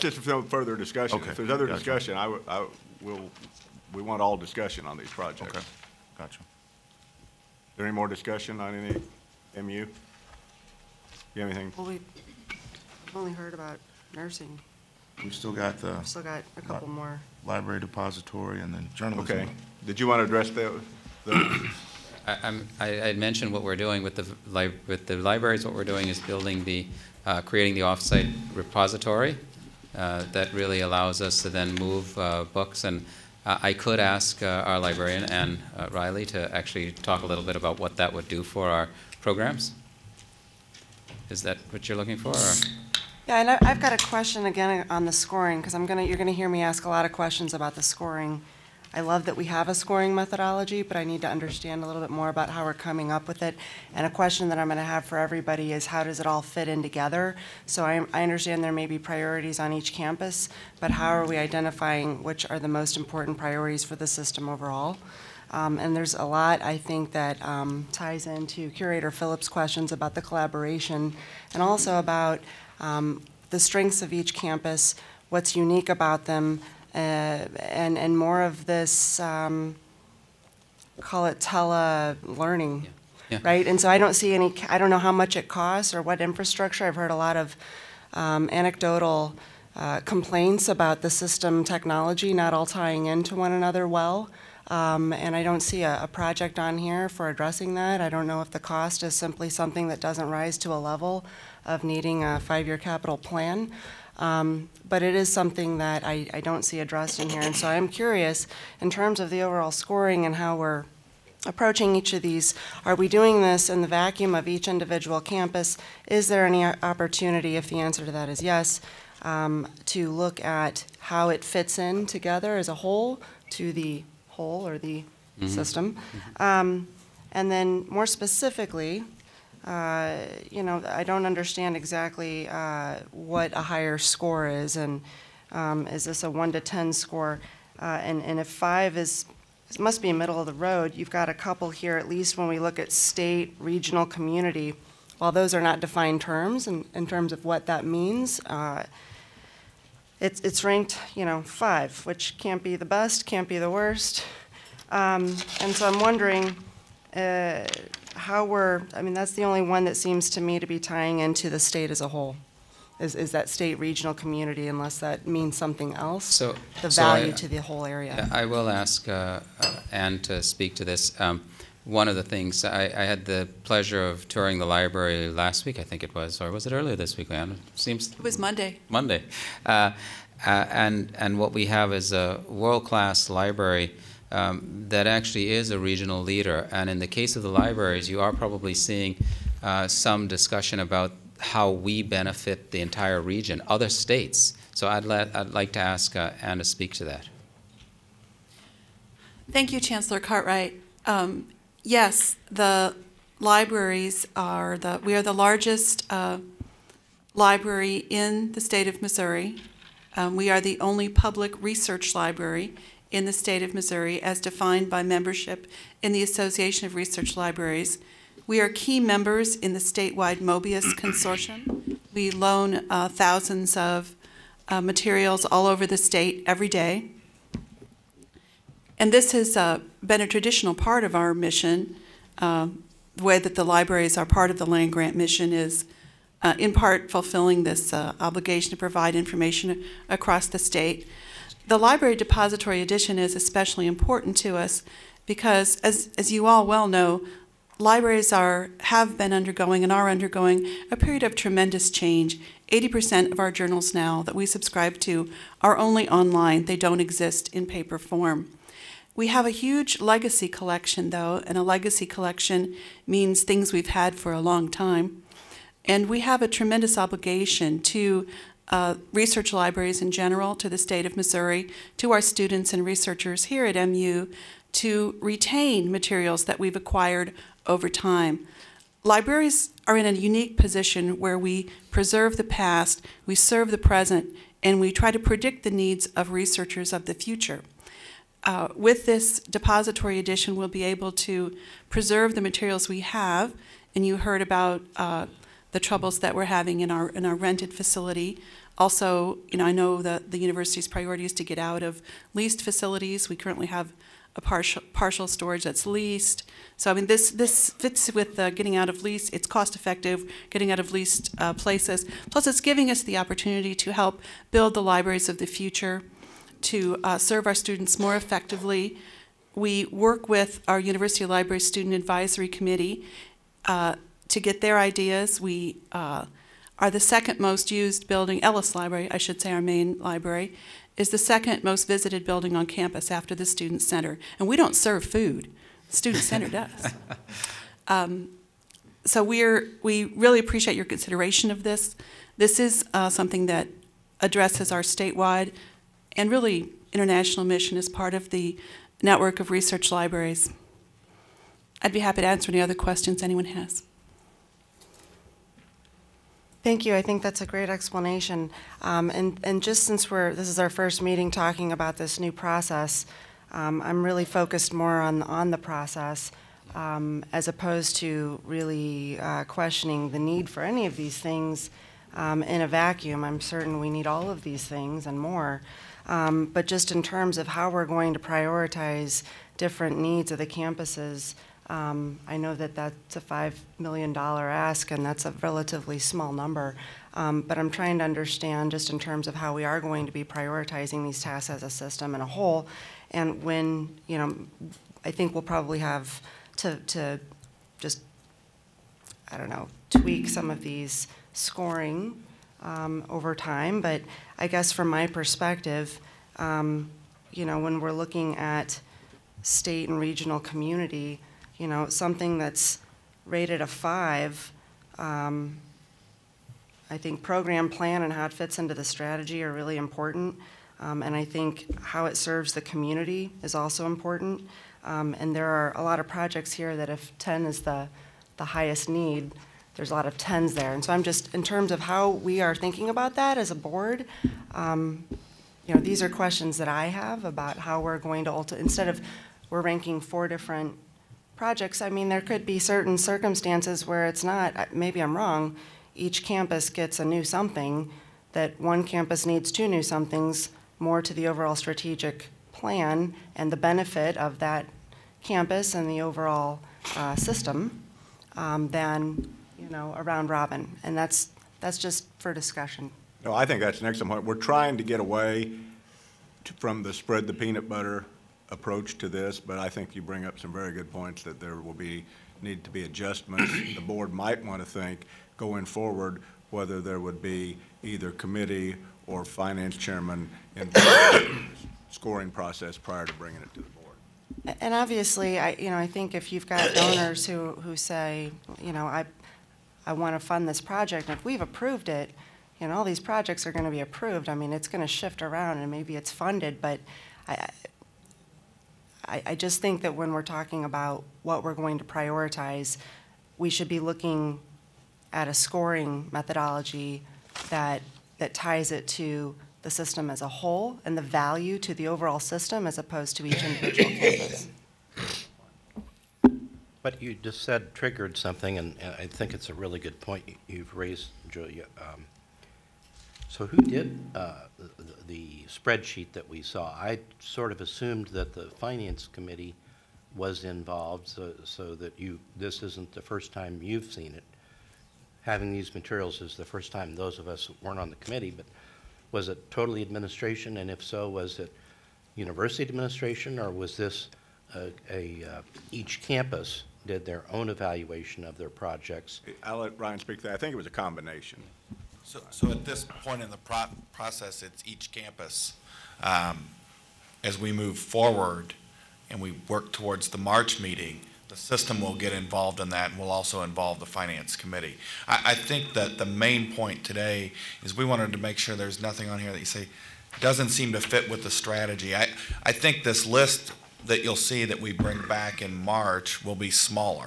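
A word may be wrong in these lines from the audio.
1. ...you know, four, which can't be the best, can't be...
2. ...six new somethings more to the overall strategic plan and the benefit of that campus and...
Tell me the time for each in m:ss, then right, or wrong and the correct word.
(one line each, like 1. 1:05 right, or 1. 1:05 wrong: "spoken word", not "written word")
1. 2:31 wrong: "five", not "four"
2. 7:29 wrong: "two", not "six".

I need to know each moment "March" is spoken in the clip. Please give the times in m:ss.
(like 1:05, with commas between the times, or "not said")
9:20, 9:35.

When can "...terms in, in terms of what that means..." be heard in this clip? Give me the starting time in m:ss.
2:26.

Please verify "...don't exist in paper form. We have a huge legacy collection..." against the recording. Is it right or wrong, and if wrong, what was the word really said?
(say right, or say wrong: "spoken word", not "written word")
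right.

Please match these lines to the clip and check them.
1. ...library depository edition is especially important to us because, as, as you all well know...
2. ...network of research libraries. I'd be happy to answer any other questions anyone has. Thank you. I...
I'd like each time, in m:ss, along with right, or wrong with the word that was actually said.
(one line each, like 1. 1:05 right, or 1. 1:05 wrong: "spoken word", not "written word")
1. 4:01 right
2. 5:49 right.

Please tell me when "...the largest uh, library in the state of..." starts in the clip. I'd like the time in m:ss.
3:25.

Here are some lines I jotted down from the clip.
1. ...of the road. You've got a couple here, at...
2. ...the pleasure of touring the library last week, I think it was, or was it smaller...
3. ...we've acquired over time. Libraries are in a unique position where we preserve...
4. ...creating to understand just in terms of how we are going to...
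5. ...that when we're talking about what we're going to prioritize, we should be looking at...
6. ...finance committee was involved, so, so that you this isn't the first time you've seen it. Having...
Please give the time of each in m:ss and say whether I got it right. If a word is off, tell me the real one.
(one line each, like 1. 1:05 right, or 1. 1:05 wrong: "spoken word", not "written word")
1. 2:20 right
2. 2:53 wrong: "earlier", not "smaller"
3. 4:36 right
4. 6:27 wrong: "trying", not "creating"
5. 8:19 right
6. 8:48 right.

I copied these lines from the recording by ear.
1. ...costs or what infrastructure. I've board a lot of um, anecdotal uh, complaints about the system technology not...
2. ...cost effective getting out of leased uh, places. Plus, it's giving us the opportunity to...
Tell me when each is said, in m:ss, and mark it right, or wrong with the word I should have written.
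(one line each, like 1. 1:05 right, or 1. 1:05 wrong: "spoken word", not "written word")
1. 1:25 wrong: "heard", not "board"
2. 5:09 right.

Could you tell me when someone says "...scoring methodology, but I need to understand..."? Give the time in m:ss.
0:49.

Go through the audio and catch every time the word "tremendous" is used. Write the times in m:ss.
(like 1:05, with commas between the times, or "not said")
4:11, 4:26.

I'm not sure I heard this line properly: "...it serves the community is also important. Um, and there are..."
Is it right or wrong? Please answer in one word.
right.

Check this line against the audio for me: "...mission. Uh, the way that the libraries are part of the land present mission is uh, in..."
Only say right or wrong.
wrong.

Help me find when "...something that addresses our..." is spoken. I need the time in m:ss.
5:43.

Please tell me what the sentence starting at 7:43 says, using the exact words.
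No, I think that's an excellent point.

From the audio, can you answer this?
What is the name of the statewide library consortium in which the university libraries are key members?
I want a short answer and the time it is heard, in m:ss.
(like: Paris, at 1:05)
Mobius Consortium, at 3:40.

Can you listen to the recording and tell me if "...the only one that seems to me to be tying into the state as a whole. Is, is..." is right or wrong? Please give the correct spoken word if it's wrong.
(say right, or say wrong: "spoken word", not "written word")
right.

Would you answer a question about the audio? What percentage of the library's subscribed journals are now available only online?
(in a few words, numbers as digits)
80%.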